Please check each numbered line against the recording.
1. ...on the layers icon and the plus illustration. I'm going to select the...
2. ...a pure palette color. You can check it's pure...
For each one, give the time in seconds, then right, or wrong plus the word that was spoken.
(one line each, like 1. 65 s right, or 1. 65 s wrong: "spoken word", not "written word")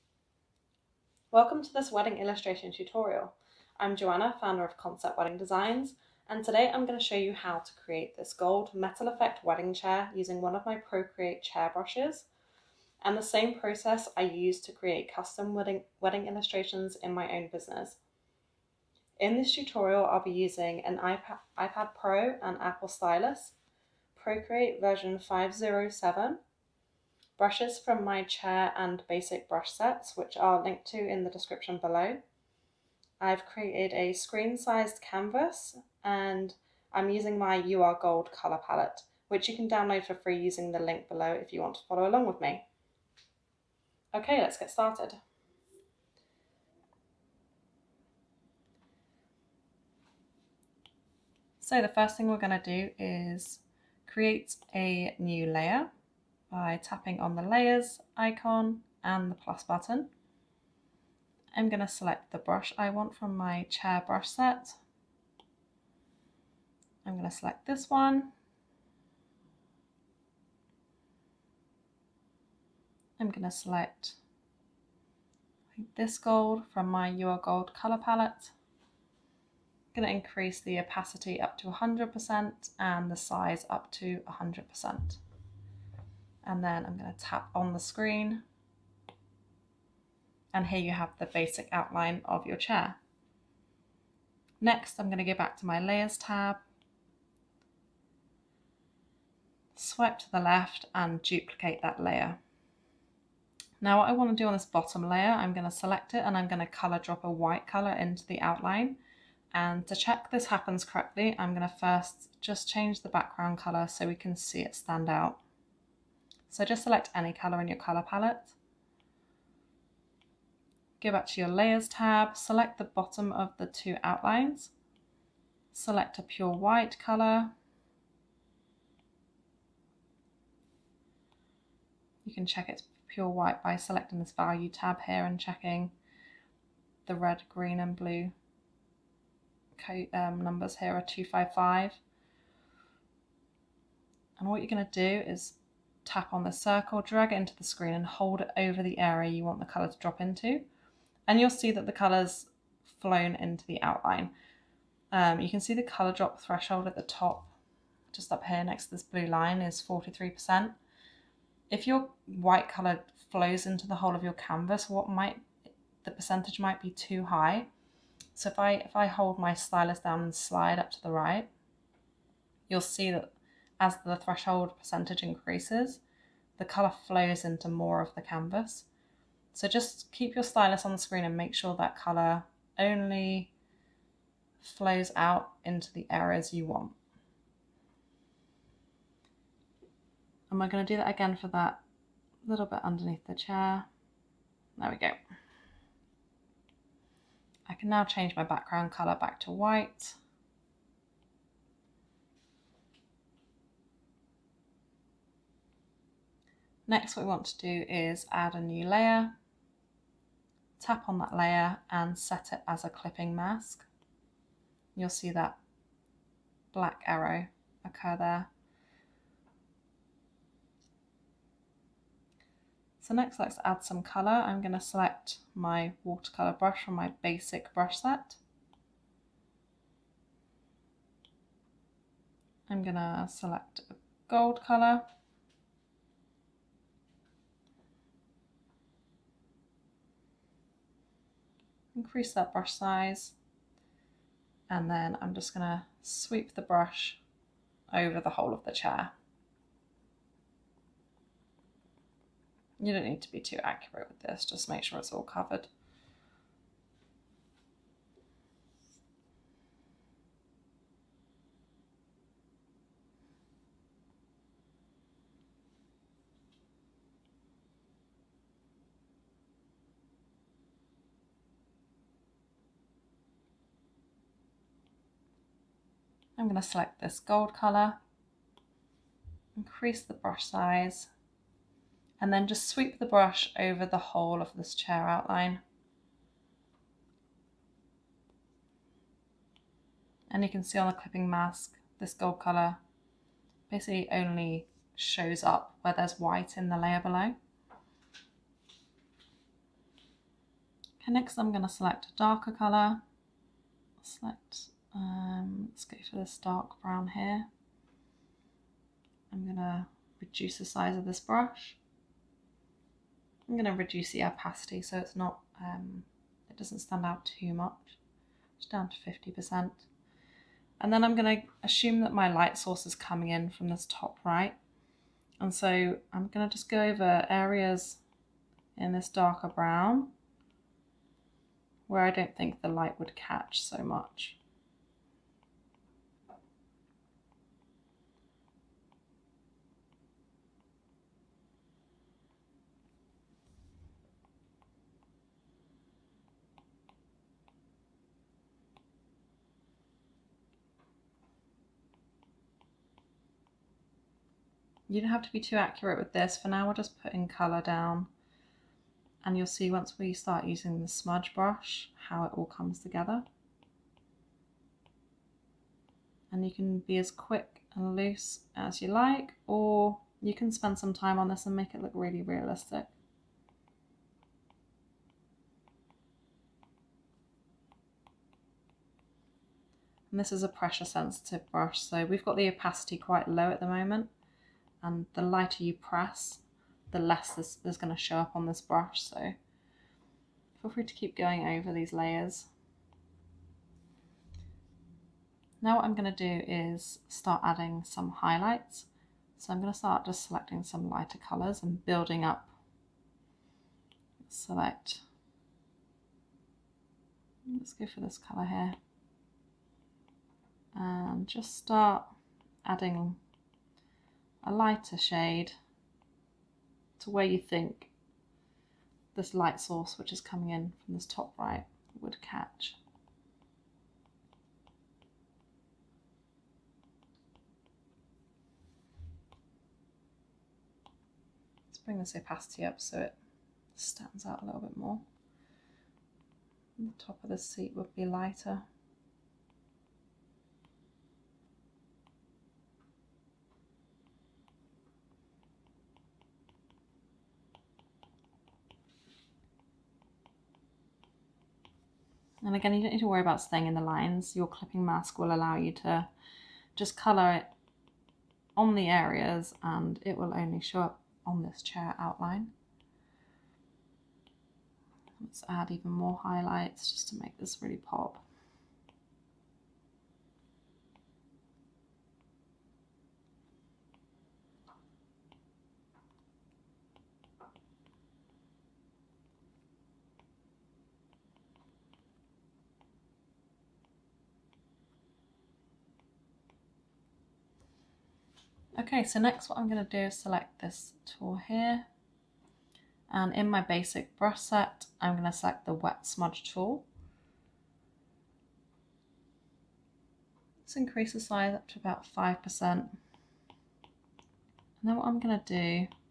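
1. 57 s wrong: "button", not "illustration"
2. 126 s wrong: "white", not "palette".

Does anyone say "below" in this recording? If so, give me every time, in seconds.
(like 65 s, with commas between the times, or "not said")
31 s, 41 s, 297 s.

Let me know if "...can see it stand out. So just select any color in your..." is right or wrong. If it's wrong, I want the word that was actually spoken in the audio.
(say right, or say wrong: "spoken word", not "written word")
right.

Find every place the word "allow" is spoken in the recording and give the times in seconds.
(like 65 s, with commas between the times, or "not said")
455 s.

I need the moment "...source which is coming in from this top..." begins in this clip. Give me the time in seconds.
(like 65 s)
419 s.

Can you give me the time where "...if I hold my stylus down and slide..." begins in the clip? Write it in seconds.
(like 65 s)
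168 s.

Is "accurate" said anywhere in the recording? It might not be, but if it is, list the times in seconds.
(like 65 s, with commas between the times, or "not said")
253 s, 355 s.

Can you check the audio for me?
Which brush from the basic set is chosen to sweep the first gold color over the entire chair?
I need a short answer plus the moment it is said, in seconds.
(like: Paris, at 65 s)
watercolour brush, at 226 s.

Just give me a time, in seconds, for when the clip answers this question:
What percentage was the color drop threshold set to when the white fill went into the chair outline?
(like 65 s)
159 s.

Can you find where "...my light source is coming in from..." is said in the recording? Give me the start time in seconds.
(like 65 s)
322 s.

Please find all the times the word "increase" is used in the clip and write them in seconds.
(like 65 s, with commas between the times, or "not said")
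80 s, 175 s, 241 s, 279 s, 500 s.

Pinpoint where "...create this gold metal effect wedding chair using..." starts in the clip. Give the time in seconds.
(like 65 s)
7 s.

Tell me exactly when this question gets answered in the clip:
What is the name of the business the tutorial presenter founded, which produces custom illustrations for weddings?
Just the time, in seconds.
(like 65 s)
4 s.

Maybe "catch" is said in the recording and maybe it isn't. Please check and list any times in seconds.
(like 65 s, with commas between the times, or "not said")
333 s, 422 s.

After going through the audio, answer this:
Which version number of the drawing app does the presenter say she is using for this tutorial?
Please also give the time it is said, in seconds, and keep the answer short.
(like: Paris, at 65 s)
507, at 25 s.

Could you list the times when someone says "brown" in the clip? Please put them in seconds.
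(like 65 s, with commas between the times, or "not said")
306 s, 329 s.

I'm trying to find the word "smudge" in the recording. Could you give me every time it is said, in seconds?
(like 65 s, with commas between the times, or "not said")
360 s, 496 s.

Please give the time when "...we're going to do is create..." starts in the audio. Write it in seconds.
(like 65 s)
52 s.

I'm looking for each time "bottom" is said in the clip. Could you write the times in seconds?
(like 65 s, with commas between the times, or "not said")
104 s, 122 s.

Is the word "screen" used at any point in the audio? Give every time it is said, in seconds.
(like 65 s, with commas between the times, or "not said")
34 s, 87 s, 147 s, 180 s.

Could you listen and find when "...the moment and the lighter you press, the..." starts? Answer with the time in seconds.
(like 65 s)
383 s.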